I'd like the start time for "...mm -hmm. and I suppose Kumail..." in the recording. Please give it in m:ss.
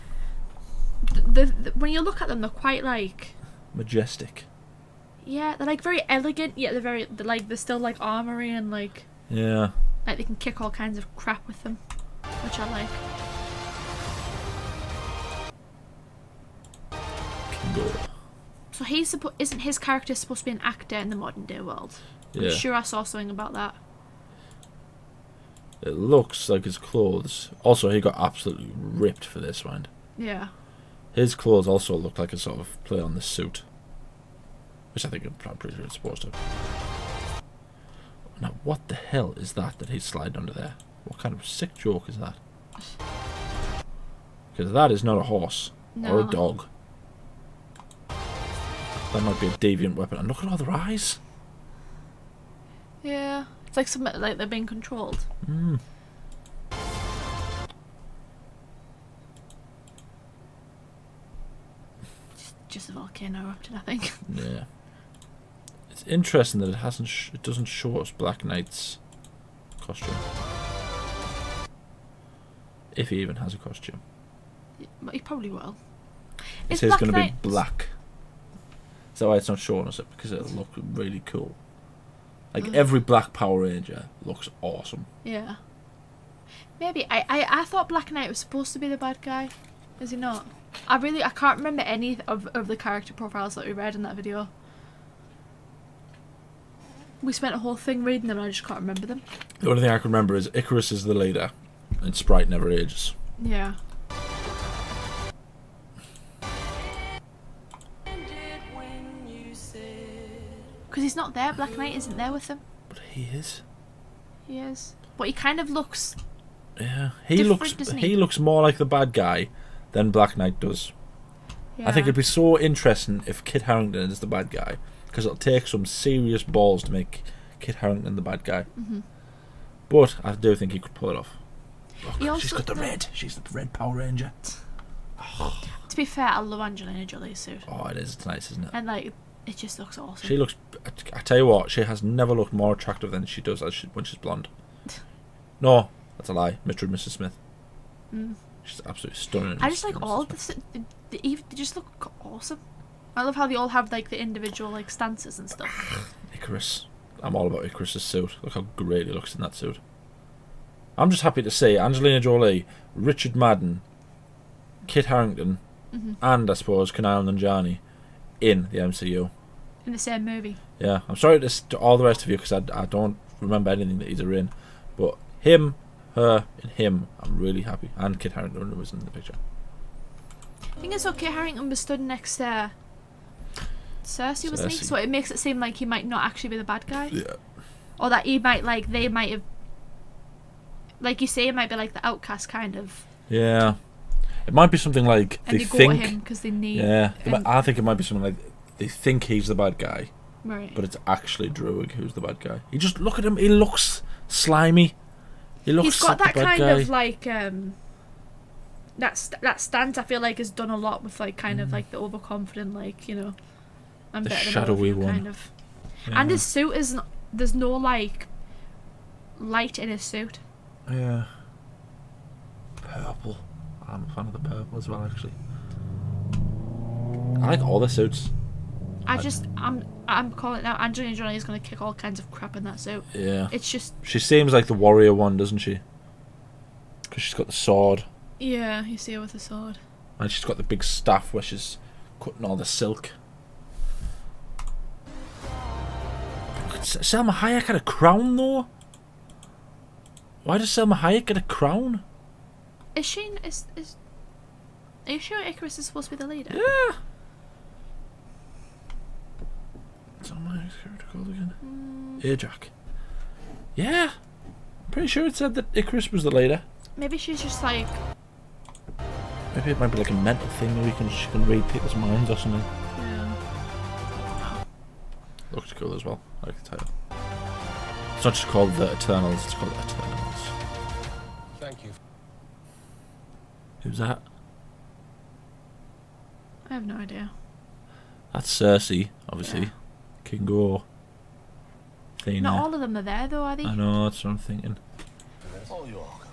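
2:45.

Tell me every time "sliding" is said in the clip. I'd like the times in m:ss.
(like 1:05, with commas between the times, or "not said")
0:40.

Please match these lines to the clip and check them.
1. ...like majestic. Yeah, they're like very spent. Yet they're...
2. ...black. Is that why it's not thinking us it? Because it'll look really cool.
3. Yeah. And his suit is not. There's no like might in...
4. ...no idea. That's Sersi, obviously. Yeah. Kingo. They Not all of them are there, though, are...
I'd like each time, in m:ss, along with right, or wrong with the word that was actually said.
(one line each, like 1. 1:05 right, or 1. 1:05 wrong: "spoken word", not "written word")
1. 0:02 wrong: "elegant", not "spent"
2. 1:17 wrong: "showing", not "thinking"
3. 3:36 wrong: "light", not "might"
4. 4:46 right.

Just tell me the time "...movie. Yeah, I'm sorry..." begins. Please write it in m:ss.
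2:50.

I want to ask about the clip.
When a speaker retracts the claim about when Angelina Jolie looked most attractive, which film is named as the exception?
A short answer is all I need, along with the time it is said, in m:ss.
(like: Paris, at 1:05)
Mr. and Mrs. Smith, at 2:26.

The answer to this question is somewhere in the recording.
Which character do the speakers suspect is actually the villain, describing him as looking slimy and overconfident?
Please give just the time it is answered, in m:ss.
3:21.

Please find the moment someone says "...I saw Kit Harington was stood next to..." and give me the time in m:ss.
3:00.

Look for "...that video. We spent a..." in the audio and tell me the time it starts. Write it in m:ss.
1:34.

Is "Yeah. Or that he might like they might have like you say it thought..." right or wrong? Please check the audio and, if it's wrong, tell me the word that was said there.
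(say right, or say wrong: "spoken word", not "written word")
wrong: "might", not "thought".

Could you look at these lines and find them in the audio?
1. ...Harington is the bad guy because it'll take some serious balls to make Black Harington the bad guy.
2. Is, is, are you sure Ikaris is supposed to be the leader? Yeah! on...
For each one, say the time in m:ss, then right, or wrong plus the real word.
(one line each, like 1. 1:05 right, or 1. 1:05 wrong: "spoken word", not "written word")
1. 2:03 wrong: "Kit", not "Black"
2. 4:13 right.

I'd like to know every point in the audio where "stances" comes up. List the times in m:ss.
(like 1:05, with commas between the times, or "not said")
2:34, 3:29.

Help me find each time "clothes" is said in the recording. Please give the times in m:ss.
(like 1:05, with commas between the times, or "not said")
0:26, 0:31.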